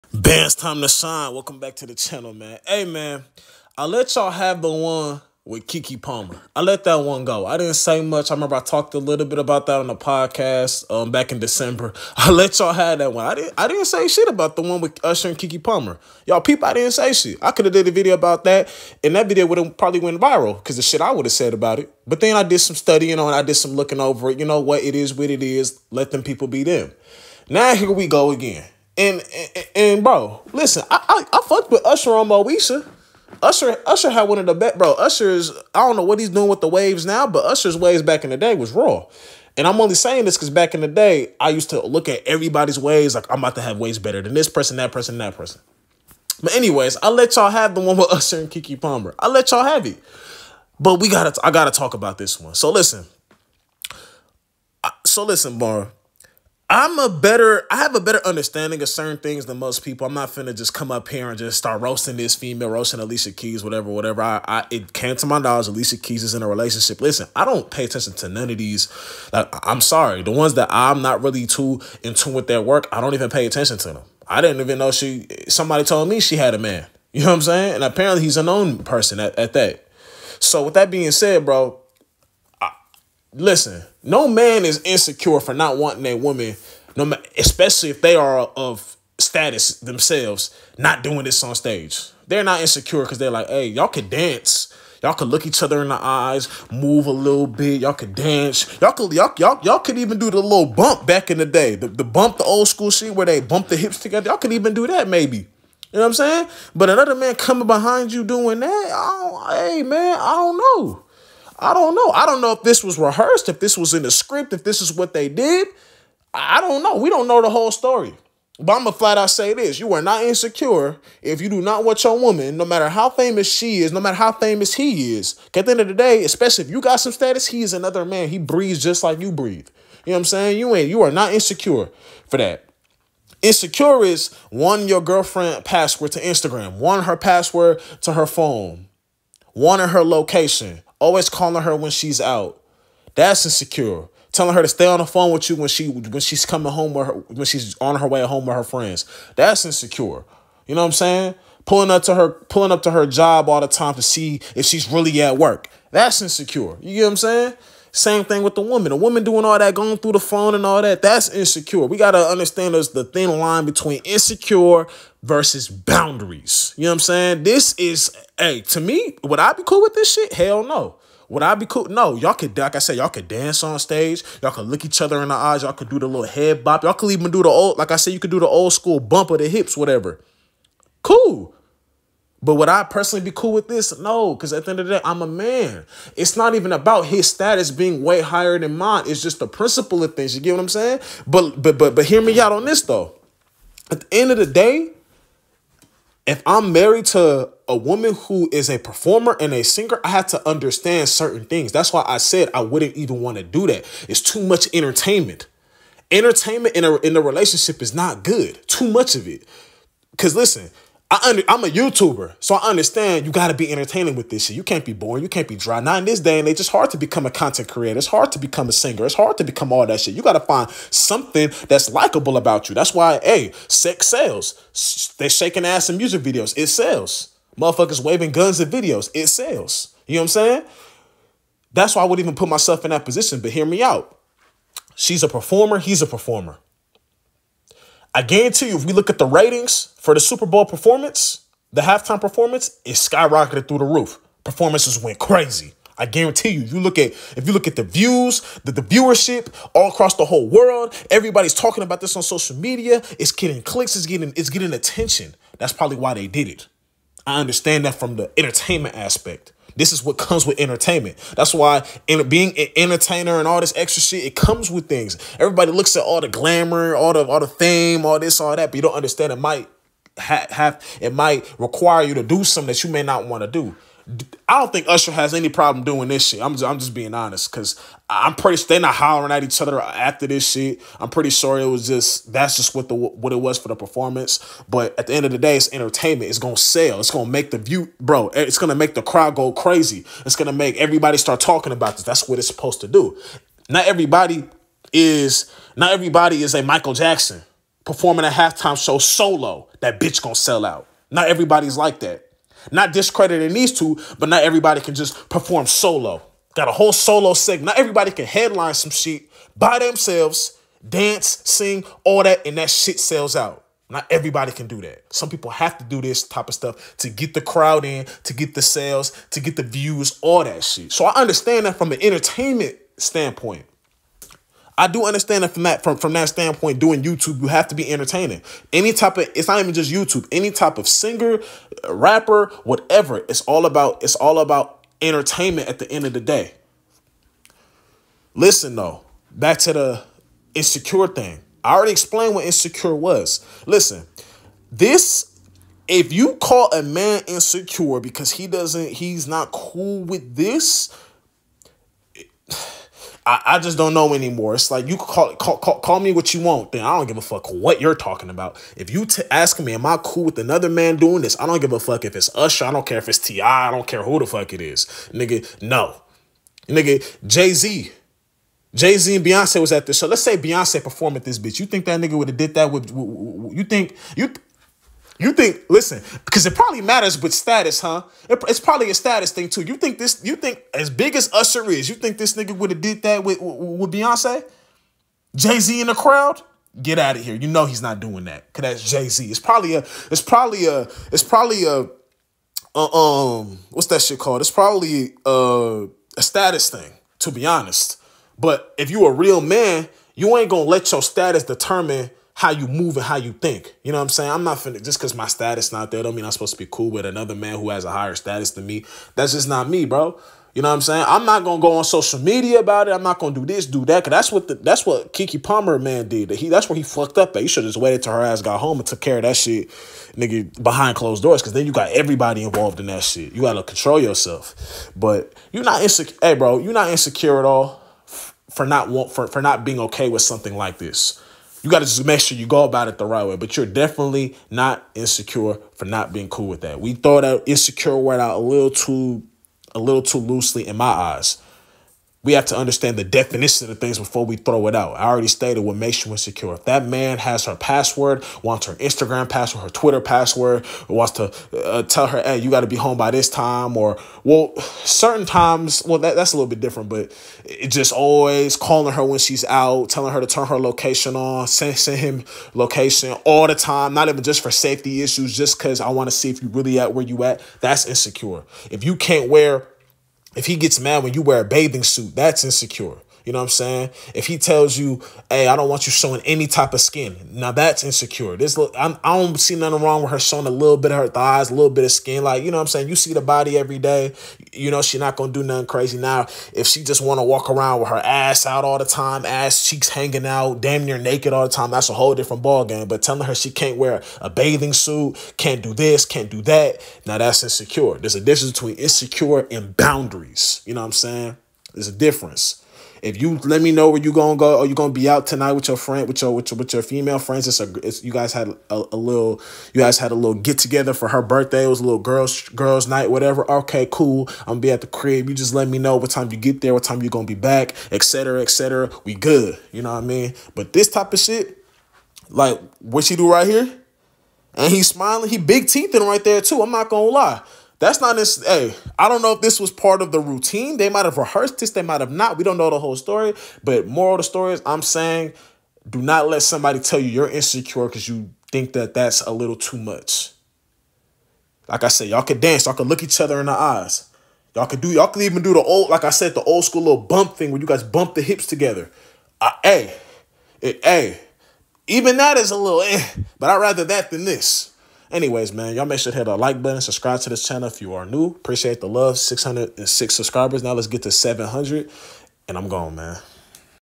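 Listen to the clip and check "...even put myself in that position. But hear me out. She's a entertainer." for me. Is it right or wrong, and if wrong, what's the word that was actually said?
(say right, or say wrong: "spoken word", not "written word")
wrong: "performer", not "entertainer".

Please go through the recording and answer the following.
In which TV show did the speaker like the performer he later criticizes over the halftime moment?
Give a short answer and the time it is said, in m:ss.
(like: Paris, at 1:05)
Moesha, at 0:32.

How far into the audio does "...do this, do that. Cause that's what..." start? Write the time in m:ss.
6:53.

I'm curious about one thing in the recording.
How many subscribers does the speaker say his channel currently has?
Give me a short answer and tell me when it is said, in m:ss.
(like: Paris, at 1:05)
606, at 9:19.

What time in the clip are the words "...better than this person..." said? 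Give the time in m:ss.
0:43.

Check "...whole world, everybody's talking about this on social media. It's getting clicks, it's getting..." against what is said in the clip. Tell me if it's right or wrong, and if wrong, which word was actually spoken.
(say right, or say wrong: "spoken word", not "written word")
right.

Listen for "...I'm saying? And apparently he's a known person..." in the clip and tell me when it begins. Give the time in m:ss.
1:17.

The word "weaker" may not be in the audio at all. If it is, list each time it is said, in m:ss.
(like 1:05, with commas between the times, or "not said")
not said.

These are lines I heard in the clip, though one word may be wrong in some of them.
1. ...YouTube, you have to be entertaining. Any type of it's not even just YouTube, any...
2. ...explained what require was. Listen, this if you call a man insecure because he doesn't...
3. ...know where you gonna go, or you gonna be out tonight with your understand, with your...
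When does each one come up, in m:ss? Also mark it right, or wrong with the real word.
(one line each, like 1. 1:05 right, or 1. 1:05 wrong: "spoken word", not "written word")
1. 5:27 right
2. 5:41 wrong: "insecure", not "require"
3. 8:23 wrong: "friend", not "understand".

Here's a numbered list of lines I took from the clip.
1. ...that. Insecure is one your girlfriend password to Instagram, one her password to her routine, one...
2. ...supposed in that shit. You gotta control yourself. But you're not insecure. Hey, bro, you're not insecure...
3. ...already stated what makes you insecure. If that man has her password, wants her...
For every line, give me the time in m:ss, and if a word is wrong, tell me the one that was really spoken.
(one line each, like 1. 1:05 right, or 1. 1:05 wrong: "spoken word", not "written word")
1. 2:12 wrong: "phone", not "routine"
2. 7:02 wrong: "involved", not "supposed"
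3. 7:25 right.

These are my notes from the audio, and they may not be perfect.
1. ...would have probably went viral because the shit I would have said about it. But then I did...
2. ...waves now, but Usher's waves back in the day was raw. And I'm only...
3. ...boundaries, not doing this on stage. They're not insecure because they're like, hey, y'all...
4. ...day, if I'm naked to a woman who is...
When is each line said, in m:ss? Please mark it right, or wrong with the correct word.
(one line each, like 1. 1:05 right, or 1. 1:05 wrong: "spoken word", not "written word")
1. 0:19 right
2. 0:36 right
3. 1:29 wrong: "themselves", not "boundaries"
4. 3:14 wrong: "married", not "naked".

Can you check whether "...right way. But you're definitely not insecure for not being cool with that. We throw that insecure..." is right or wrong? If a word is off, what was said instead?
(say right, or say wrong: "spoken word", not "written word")
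right.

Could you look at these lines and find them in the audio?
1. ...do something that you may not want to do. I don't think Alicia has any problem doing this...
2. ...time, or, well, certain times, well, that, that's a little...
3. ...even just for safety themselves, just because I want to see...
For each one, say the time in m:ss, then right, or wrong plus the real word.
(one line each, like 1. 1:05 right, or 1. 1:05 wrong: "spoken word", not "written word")
1. 4:32 wrong: "Usher", not "Alicia"
2. 7:33 right
3. 7:44 wrong: "issues", not "themselves".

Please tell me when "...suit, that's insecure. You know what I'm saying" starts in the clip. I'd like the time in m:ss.
7:51.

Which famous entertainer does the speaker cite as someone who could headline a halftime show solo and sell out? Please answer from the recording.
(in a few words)
Michael Jackson.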